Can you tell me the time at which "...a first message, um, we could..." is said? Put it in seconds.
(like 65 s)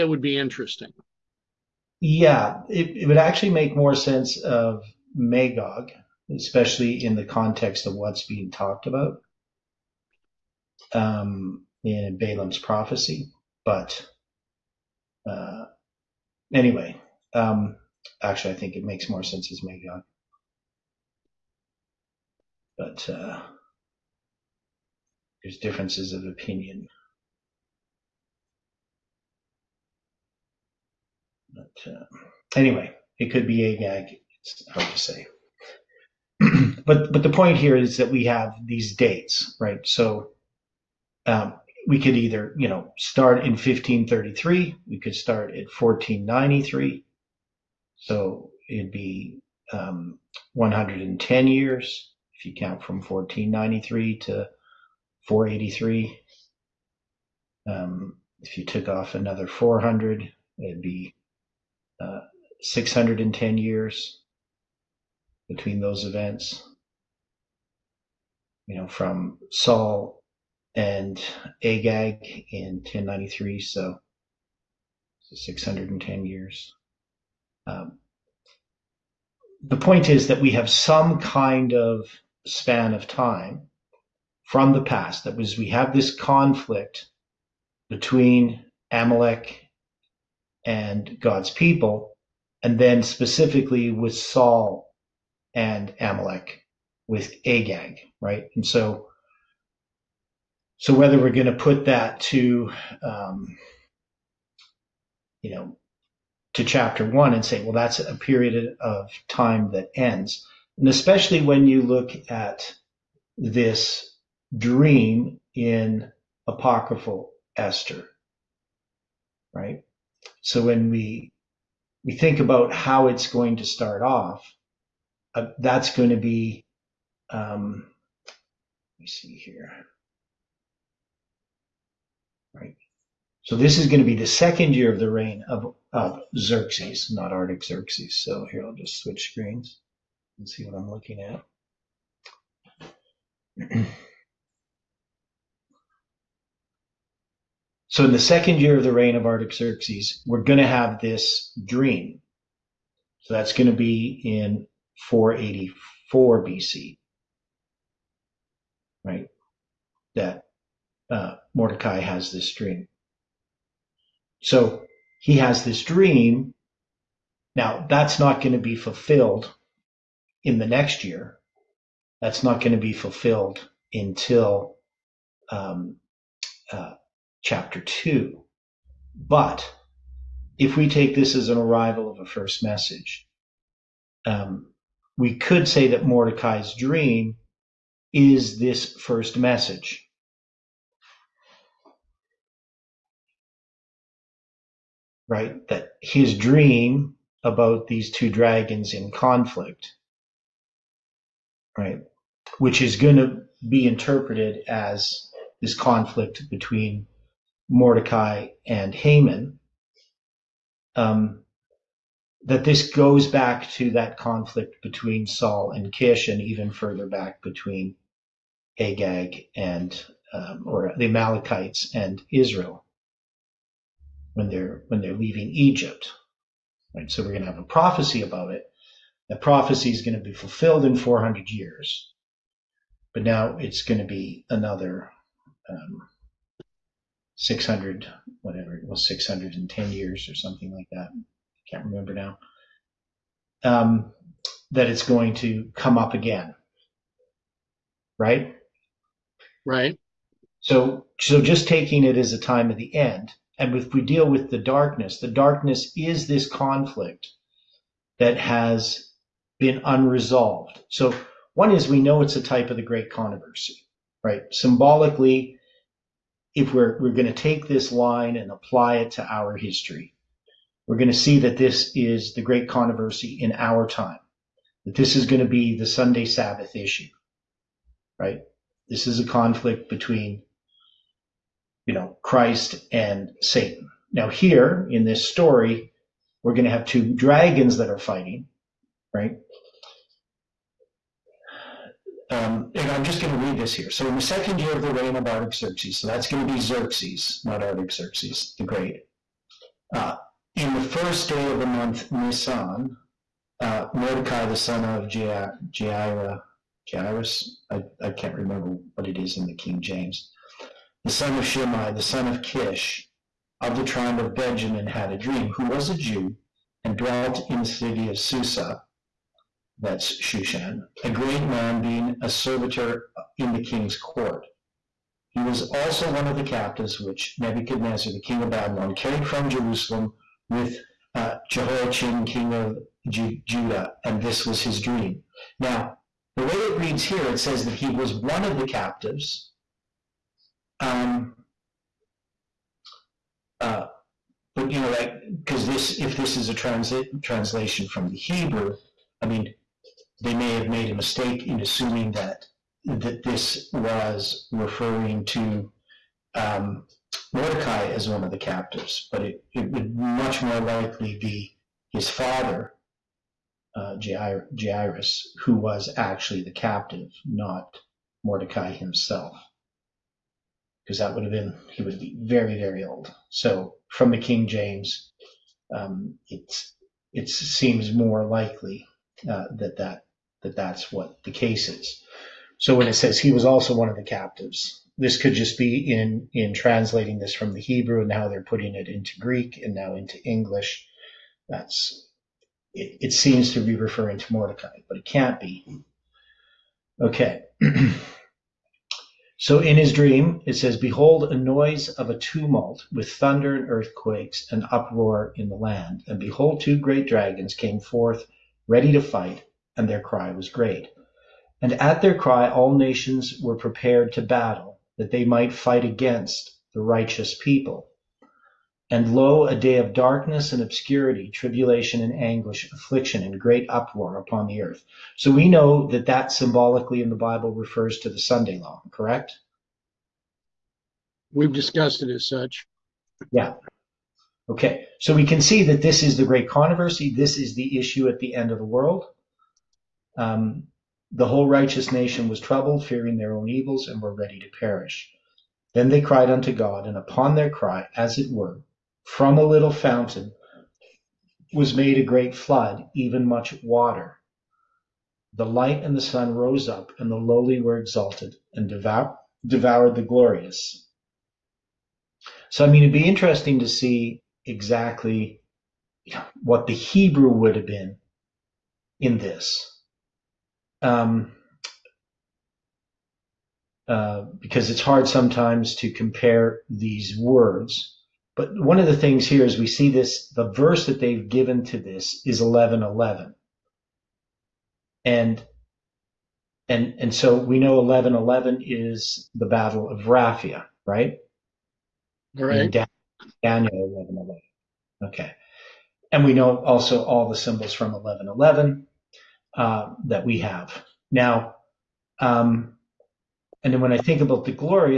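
182 s.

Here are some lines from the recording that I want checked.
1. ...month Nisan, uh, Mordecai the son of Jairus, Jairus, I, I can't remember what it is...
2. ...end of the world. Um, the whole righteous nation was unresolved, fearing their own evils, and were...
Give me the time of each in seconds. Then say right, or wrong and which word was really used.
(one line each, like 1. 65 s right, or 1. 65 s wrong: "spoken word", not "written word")
1. 301 s right
2. 438 s wrong: "troubled", not "unresolved".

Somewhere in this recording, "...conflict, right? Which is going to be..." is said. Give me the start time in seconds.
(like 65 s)
199 s.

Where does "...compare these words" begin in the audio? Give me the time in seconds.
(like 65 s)
475 s.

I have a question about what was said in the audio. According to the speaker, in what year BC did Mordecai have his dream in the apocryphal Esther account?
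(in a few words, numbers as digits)
484 BC.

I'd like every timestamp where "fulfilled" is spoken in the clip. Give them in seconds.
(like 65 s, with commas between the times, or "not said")
168 s, 172 s, 230 s.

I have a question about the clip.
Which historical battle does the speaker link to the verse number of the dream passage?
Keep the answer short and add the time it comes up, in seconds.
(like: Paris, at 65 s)
Battle of Raphia, at 489 s.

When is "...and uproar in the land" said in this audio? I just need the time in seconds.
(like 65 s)
404 s.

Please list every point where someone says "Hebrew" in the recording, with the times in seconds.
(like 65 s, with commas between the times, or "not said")
348 s, 387 s, 466 s.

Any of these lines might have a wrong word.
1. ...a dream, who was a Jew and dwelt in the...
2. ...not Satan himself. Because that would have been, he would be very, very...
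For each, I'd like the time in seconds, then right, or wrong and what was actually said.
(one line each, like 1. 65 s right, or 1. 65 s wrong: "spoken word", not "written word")
1. 315 s right
2. 367 s wrong: "Mordecai", not "Satan".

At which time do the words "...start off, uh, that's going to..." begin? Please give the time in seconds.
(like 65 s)
123 s.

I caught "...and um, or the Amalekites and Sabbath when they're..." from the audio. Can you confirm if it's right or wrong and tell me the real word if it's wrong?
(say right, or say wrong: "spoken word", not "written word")
wrong: "Israel", not "Sabbath".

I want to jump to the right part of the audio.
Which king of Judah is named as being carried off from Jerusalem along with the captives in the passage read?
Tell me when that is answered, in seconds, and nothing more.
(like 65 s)
331 s.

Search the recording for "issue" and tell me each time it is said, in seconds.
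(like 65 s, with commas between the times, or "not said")
276 s, 437 s.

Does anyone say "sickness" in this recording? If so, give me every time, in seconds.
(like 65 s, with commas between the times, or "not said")
not said.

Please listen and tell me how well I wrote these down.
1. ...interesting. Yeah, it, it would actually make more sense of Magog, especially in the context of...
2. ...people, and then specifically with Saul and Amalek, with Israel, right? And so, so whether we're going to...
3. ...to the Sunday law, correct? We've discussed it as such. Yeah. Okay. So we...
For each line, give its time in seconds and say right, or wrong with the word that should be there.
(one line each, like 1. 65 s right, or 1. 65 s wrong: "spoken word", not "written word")
1. 0 s right
2. 91 s wrong: "Agag", not "Israel"
3. 427 s right.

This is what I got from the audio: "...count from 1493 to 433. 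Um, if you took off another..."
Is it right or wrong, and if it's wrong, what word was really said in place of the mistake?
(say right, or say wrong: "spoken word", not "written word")
wrong: "483", not "433".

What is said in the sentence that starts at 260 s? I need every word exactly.
So, one is we know it's a type of the great controversy, right?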